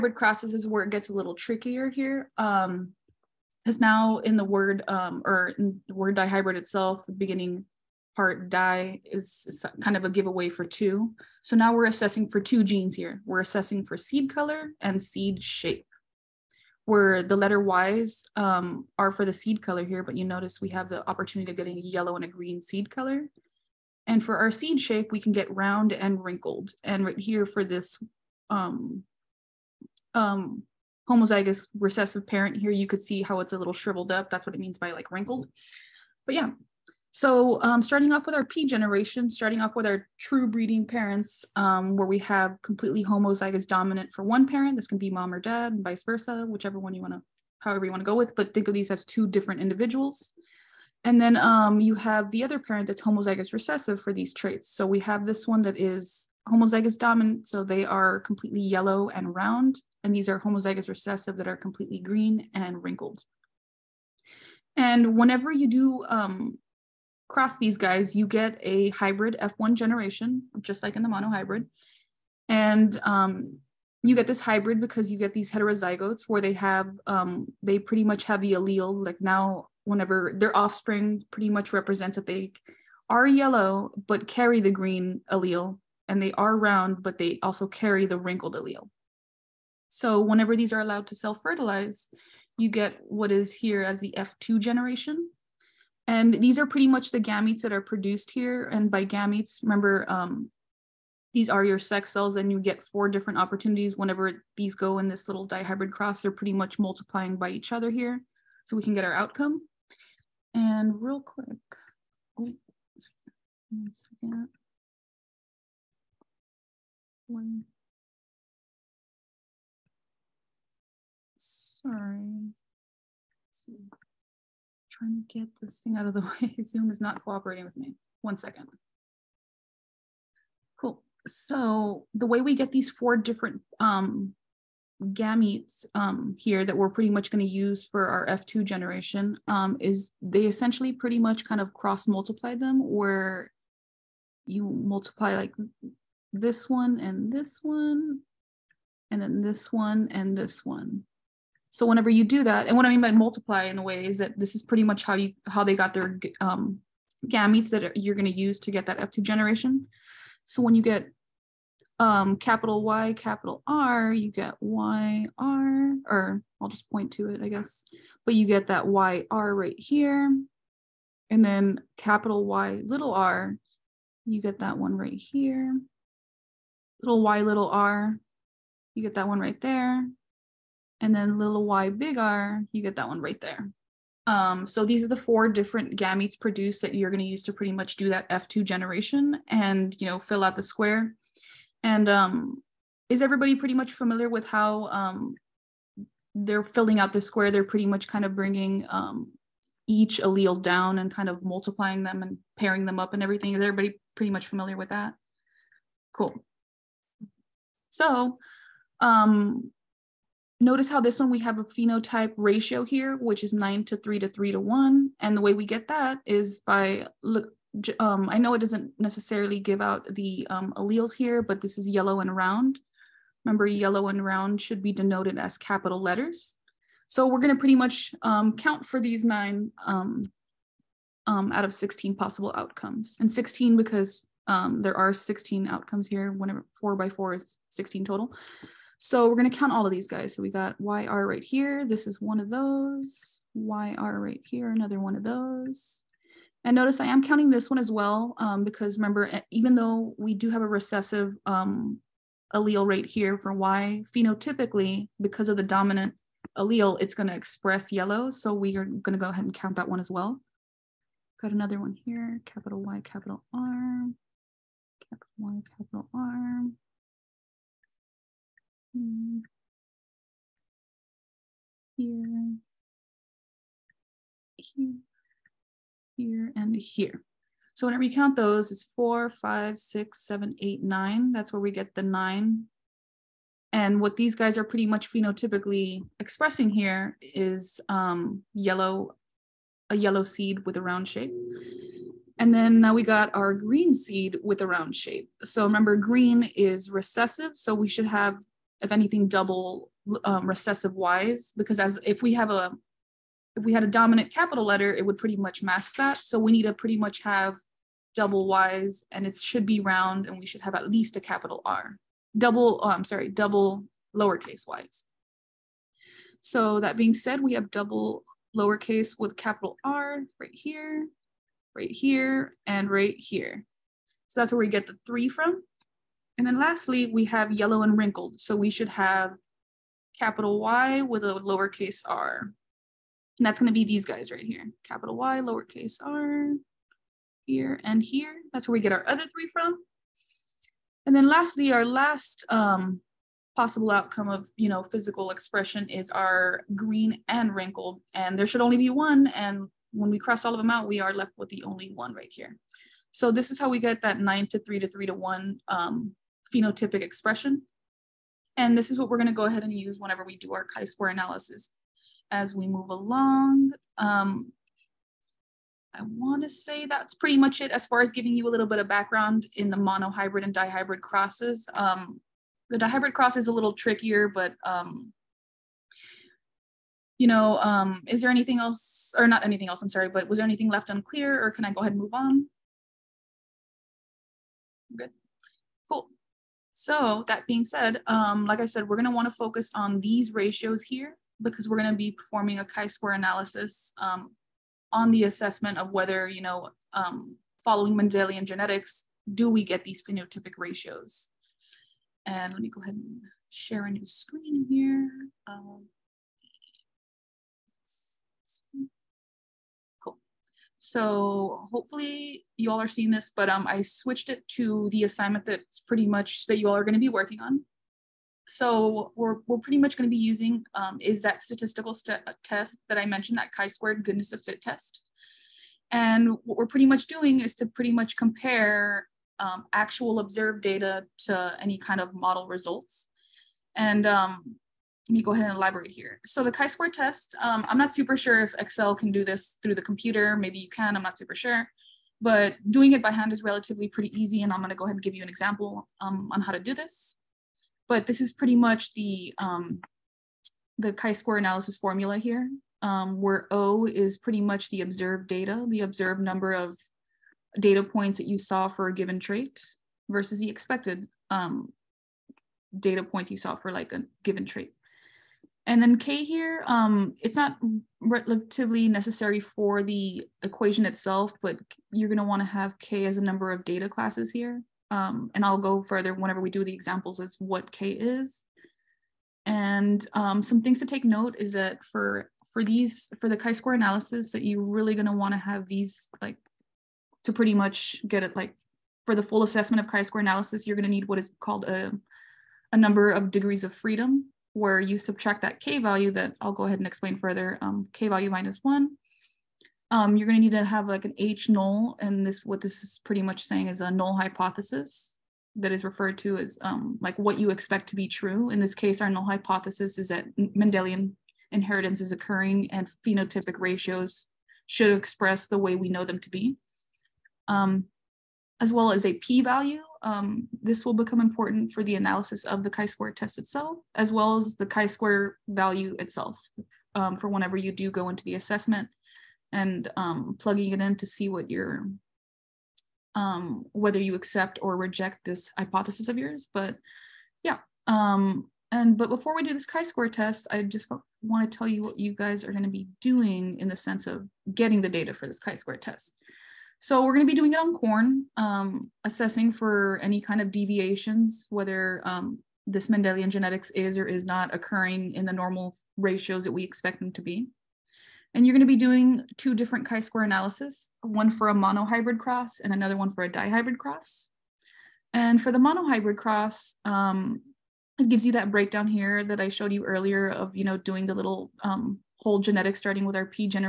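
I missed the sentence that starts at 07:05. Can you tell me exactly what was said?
And what we're pretty much doing is to pretty much compare um, actual observed data to any kind of model results.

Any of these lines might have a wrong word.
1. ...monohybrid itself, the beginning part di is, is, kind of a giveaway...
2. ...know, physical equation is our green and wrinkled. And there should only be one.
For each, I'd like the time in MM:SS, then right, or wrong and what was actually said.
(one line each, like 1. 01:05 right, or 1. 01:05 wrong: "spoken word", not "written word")
1. 00:06 wrong: "dihybrid", not "monohybrid"
2. 05:44 wrong: "expression", not "equation".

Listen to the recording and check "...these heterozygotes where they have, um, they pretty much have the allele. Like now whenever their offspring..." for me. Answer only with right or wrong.
right.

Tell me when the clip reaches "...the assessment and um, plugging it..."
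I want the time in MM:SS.
08:48.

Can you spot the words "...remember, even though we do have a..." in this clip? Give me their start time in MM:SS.
04:08.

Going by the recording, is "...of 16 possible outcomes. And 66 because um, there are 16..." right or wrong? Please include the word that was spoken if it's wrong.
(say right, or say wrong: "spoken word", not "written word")
wrong: "16", not "66".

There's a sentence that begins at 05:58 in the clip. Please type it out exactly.
And this is what we're gonna go ahead and use whenever we do our chi-square analysis as we move along.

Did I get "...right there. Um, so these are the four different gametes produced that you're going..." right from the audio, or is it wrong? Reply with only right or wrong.
right.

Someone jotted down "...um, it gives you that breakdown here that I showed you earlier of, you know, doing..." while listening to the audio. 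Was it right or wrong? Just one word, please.
right.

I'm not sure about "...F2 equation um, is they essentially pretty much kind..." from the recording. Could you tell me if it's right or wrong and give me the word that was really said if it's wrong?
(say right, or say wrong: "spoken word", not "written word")
wrong: "generation", not "equation".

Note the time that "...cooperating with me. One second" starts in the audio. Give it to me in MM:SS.
02:07.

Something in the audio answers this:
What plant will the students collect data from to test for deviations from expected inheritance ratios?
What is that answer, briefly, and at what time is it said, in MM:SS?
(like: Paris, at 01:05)
Corn, at 09:07.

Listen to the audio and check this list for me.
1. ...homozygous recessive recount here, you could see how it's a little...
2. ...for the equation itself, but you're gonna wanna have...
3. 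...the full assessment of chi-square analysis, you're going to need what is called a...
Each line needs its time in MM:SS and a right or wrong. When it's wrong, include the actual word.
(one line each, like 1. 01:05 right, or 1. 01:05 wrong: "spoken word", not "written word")
1. 00:31 wrong: "parent", not "recount"
2. 07:49 right
3. 08:09 right.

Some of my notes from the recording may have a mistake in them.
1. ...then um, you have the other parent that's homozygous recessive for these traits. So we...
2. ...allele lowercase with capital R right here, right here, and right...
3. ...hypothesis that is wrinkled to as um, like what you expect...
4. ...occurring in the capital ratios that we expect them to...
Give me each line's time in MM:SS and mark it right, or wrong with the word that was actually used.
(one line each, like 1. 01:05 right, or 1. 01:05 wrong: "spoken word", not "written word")
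1. 00:51 right
2. 05:17 wrong: "double", not "allele"
3. 08:24 wrong: "referred", not "wrinkled"
4. 09:14 wrong: "normal", not "capital".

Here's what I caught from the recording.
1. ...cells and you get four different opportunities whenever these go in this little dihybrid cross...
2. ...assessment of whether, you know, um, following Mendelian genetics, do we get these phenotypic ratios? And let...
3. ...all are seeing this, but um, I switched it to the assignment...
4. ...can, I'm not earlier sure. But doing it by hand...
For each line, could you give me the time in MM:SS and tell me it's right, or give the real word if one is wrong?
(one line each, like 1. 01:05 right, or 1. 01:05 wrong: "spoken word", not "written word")
1. 01:42 right
2. 06:35 right
3. 06:52 right
4. 07:20 wrong: "super", not "earlier".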